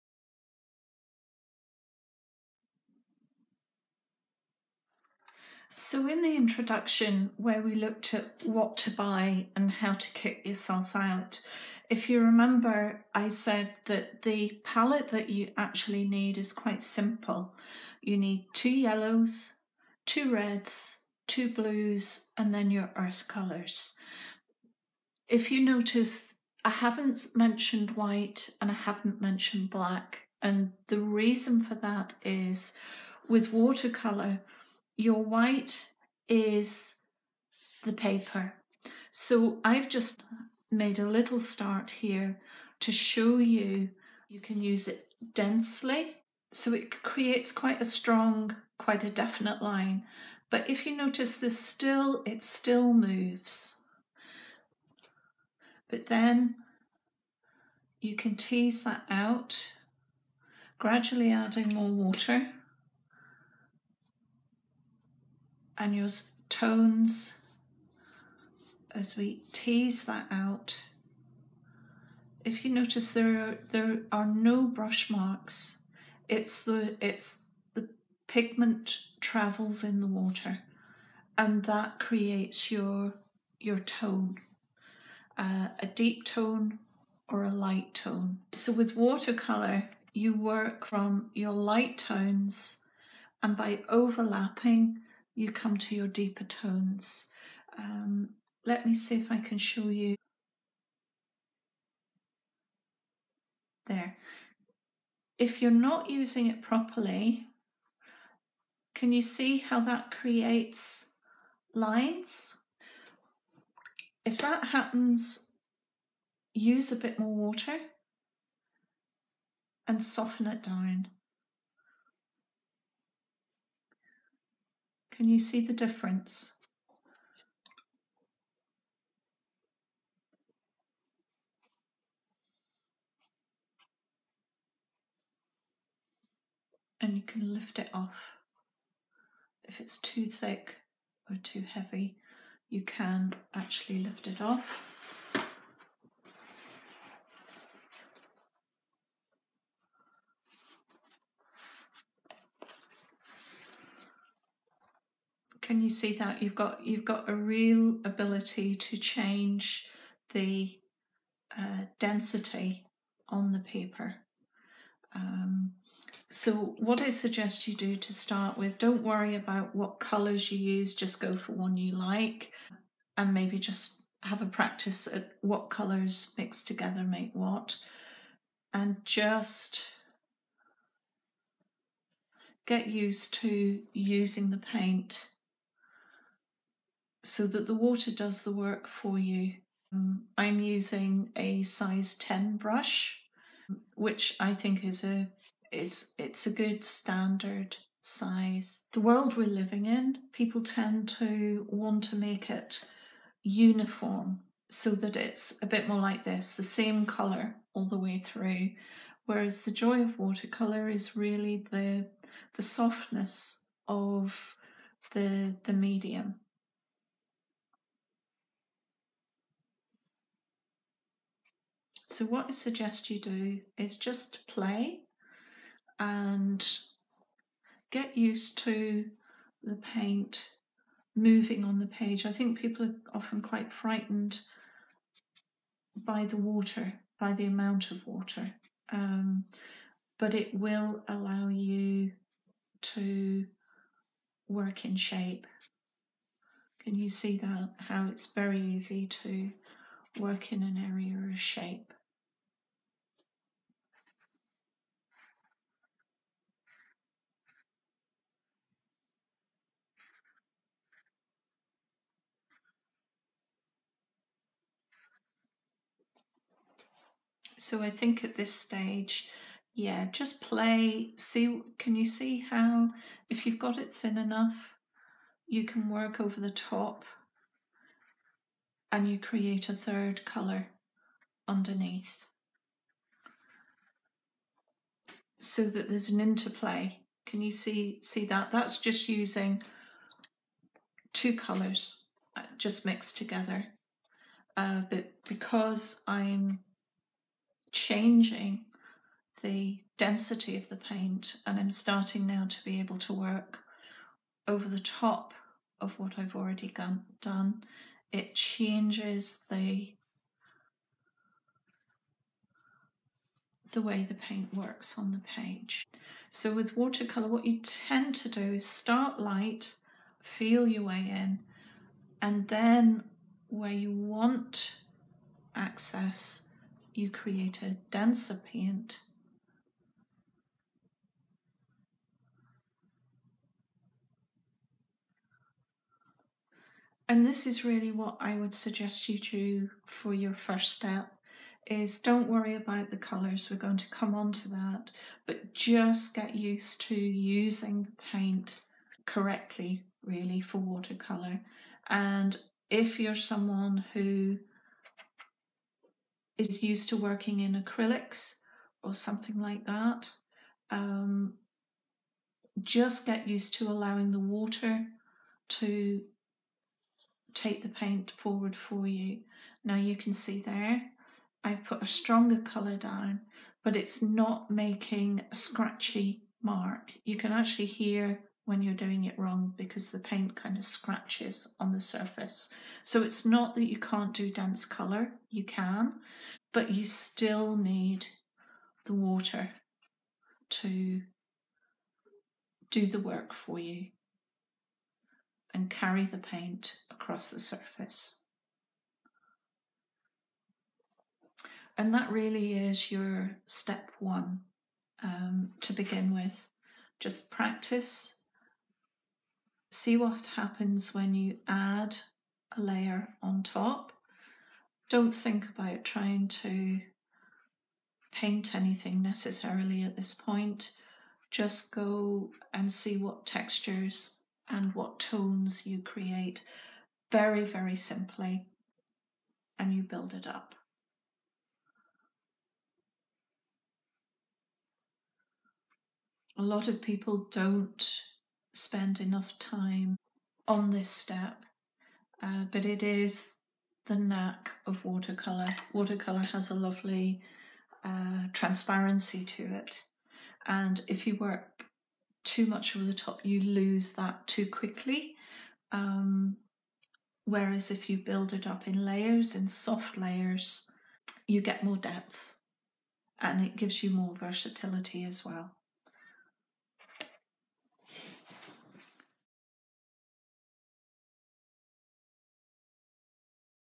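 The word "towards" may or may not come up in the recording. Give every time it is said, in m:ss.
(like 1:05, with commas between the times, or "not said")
not said.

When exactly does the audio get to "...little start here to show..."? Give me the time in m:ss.
0:41.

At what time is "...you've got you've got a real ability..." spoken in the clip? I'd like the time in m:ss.
2:36.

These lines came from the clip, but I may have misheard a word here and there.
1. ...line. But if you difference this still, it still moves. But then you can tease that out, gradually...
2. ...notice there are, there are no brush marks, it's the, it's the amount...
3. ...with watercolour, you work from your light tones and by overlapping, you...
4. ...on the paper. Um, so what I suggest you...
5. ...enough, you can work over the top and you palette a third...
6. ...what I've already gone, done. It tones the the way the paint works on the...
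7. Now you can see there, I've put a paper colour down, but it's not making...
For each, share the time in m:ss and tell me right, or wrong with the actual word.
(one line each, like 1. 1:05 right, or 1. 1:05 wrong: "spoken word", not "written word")
1. 0:49 wrong: "notice", not "difference"
2. 1:12 wrong: "pigment", not "amount"
3. 1:28 right
4. 2:43 right
5. 4:34 wrong: "create", not "palette"
6. 5:05 wrong: "changes", not "tones"
7. 6:09 wrong: "stronger", not "paper".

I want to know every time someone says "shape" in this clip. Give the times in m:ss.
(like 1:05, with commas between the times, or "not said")
4:04, 4:11.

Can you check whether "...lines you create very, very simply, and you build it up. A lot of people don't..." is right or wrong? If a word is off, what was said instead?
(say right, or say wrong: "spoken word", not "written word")
wrong: "tones", not "lines".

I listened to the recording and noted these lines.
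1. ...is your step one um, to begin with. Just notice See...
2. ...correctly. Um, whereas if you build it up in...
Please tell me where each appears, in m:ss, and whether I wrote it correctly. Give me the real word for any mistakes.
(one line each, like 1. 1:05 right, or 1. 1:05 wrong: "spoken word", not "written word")
1. 6:42 wrong: "practice", not "notice"
2. 7:34 wrong: "quickly", not "correctly".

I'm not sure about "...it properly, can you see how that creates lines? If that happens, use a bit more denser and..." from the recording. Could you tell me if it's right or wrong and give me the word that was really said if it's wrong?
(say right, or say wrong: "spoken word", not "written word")
wrong: "water", not "denser".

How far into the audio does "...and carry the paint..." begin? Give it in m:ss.
6:35.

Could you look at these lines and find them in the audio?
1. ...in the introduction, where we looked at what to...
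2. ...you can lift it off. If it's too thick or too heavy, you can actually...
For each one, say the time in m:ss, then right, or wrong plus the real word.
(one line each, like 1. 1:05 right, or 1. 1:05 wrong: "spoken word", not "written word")
1. 0:06 right
2. 2:17 right.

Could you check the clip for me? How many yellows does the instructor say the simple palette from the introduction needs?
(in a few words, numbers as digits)
2.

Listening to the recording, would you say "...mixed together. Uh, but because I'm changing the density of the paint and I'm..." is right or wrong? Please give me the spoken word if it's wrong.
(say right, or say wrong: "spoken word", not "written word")
right.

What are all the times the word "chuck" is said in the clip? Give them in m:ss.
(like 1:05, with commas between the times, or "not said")
not said.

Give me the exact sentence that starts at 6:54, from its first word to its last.
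Don't think about trying to paint anything necessarily at this point.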